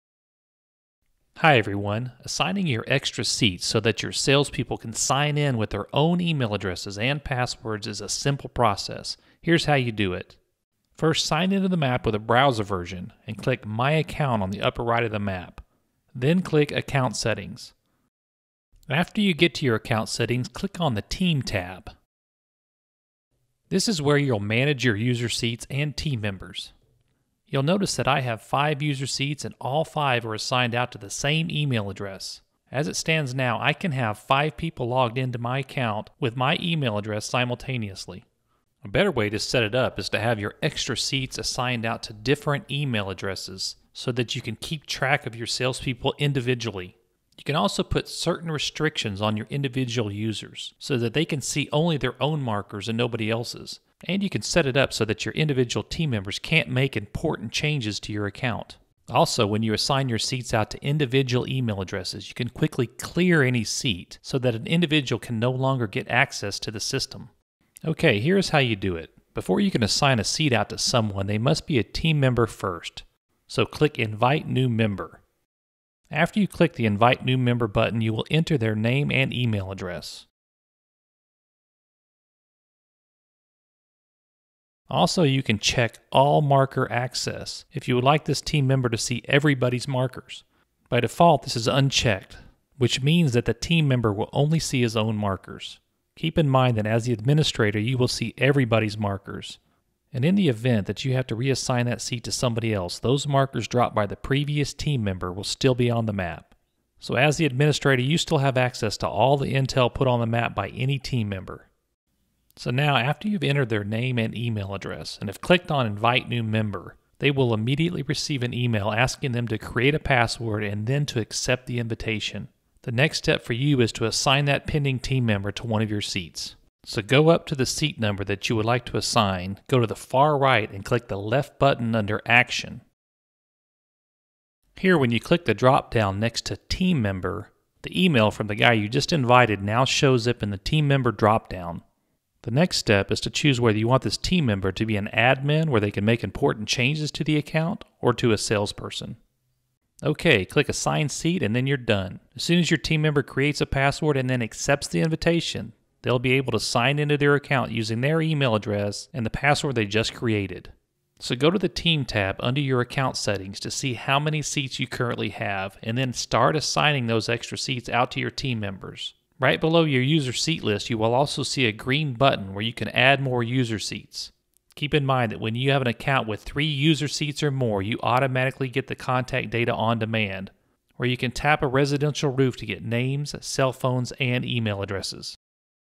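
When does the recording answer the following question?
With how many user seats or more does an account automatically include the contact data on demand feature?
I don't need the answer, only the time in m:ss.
2:56.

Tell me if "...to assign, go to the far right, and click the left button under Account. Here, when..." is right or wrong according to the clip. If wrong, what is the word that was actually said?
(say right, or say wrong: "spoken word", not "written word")
wrong: "Action", not "Account".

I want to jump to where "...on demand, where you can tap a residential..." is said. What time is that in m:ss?
2:59.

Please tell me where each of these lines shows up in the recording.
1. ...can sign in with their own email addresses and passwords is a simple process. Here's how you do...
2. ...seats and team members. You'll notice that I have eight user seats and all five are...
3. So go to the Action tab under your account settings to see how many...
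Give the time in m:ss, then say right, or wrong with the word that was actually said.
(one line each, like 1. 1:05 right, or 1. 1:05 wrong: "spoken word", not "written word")
1. 0:04 right
2. 0:25 wrong: "five", not "eight"
3. 2:41 wrong: "Team", not "Action".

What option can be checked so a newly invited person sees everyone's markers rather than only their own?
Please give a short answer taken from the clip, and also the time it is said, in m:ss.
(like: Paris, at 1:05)
All marker access, at 1:26.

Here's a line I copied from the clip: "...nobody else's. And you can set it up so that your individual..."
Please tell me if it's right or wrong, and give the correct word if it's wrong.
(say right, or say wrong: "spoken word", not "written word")
right.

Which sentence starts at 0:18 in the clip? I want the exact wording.
After you get to your account settings, click on the Team tab.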